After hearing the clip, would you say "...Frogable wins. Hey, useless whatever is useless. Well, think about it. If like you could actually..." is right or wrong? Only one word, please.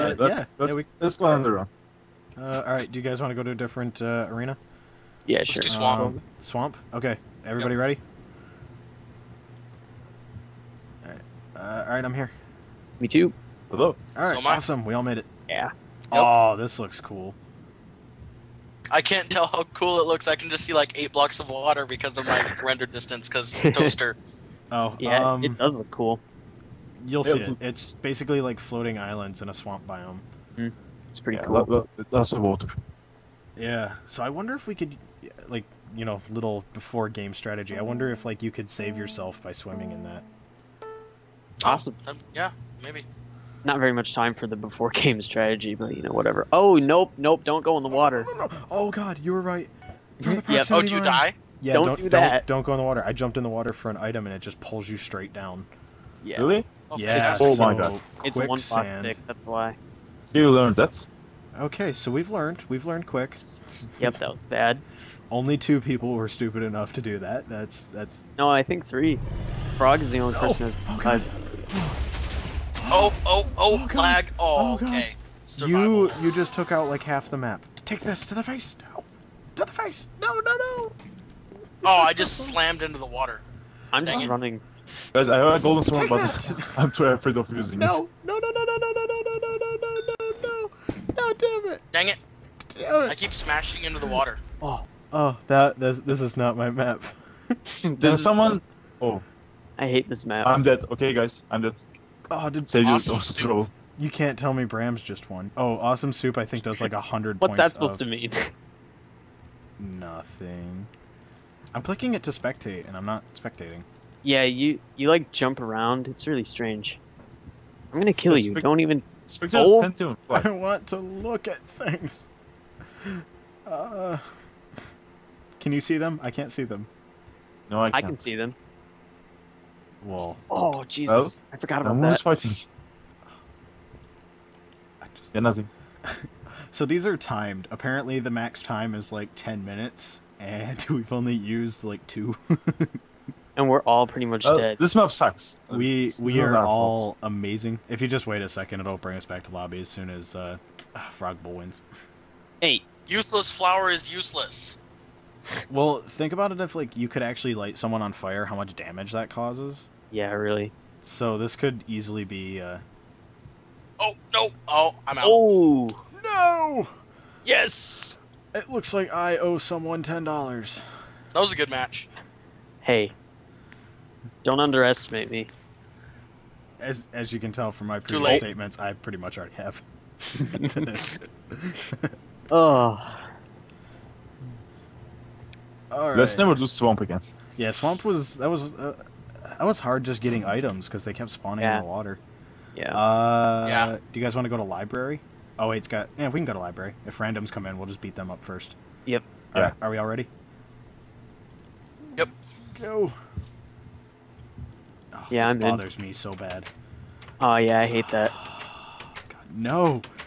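wrong.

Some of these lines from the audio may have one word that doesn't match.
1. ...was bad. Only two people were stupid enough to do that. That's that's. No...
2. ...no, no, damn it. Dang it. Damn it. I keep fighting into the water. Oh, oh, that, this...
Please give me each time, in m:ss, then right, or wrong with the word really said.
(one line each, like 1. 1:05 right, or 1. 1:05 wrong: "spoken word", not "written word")
1. 1:04 right
2. 1:30 wrong: "smashing", not "fighting".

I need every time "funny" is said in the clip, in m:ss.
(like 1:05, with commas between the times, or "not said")
not said.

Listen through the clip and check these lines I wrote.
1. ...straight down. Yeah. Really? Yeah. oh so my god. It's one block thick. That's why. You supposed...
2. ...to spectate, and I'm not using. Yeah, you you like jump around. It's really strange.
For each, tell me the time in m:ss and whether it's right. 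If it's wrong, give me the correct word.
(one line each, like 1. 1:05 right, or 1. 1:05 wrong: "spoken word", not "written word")
1. 0:54 wrong: "learned", not "supposed"
2. 1:52 wrong: "spectating", not "using".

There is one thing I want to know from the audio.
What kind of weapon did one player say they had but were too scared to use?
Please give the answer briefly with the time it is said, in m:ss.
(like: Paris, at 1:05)
Golden sword, at 1:25.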